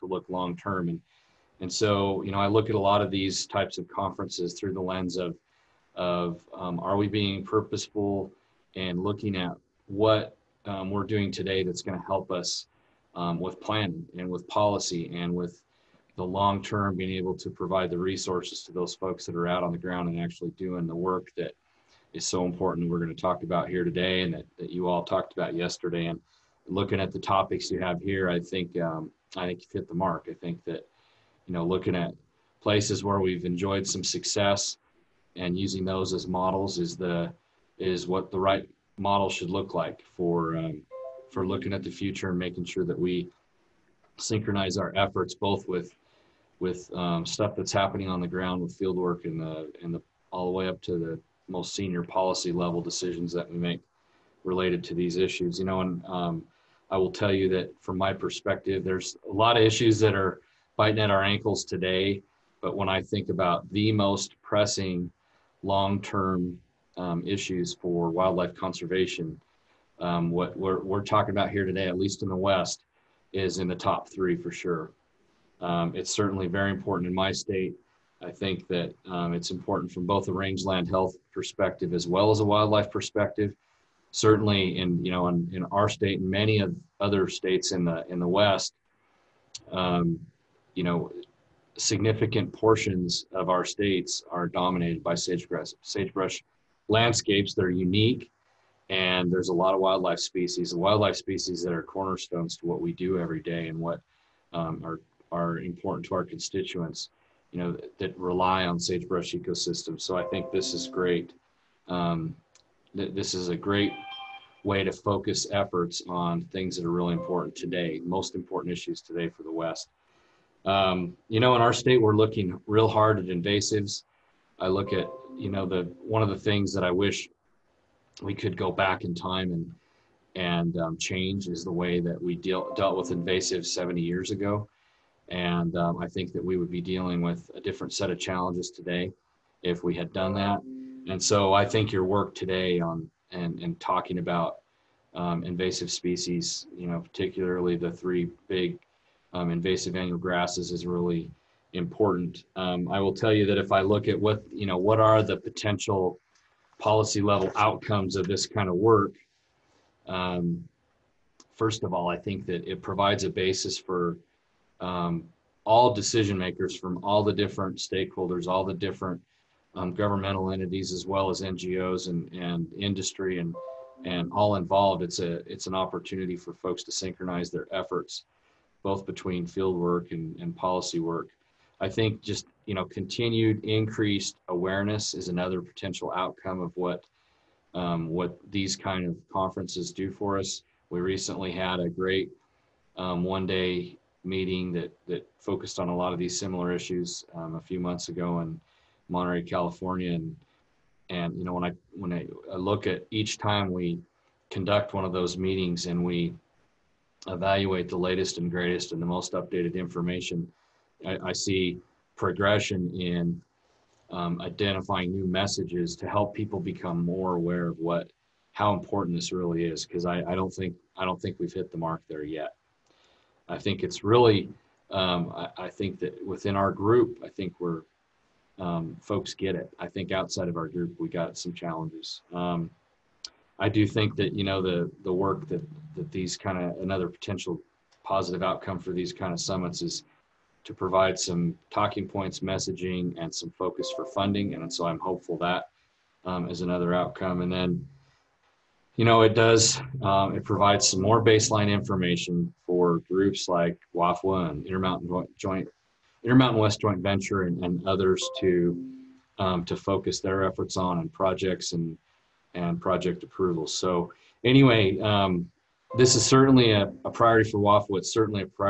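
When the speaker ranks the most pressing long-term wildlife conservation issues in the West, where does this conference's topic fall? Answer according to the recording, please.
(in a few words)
Top three.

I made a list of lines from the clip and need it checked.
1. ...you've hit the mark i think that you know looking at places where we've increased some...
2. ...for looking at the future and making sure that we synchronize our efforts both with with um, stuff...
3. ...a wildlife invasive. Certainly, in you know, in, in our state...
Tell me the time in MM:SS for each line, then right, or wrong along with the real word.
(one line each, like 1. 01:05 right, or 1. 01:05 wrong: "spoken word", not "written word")
1. 00:29 wrong: "enjoyed", not "increased"
2. 00:41 right
3. 01:22 wrong: "perspective", not "invasive".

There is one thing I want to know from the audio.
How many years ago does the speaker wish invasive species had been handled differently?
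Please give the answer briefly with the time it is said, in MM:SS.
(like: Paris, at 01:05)
70 years, at 02:13.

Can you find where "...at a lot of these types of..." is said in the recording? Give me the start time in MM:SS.
00:02.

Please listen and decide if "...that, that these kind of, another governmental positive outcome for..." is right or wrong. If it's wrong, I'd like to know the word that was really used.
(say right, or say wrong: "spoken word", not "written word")
wrong: "potential", not "governmental".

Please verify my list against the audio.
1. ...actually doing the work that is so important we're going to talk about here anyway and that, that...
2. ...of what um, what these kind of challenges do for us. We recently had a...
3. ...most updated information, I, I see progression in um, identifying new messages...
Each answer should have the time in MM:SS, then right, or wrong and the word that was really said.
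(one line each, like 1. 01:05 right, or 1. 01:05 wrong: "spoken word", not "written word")
1. 00:20 wrong: "today", not "anyway"
2. 03:06 wrong: "conferences", not "challenges"
3. 03:29 right.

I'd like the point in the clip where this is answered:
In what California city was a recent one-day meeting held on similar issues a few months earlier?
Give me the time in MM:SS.
03:19.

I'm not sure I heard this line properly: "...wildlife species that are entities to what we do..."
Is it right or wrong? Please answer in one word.
wrong.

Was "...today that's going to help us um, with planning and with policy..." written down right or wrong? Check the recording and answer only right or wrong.
right.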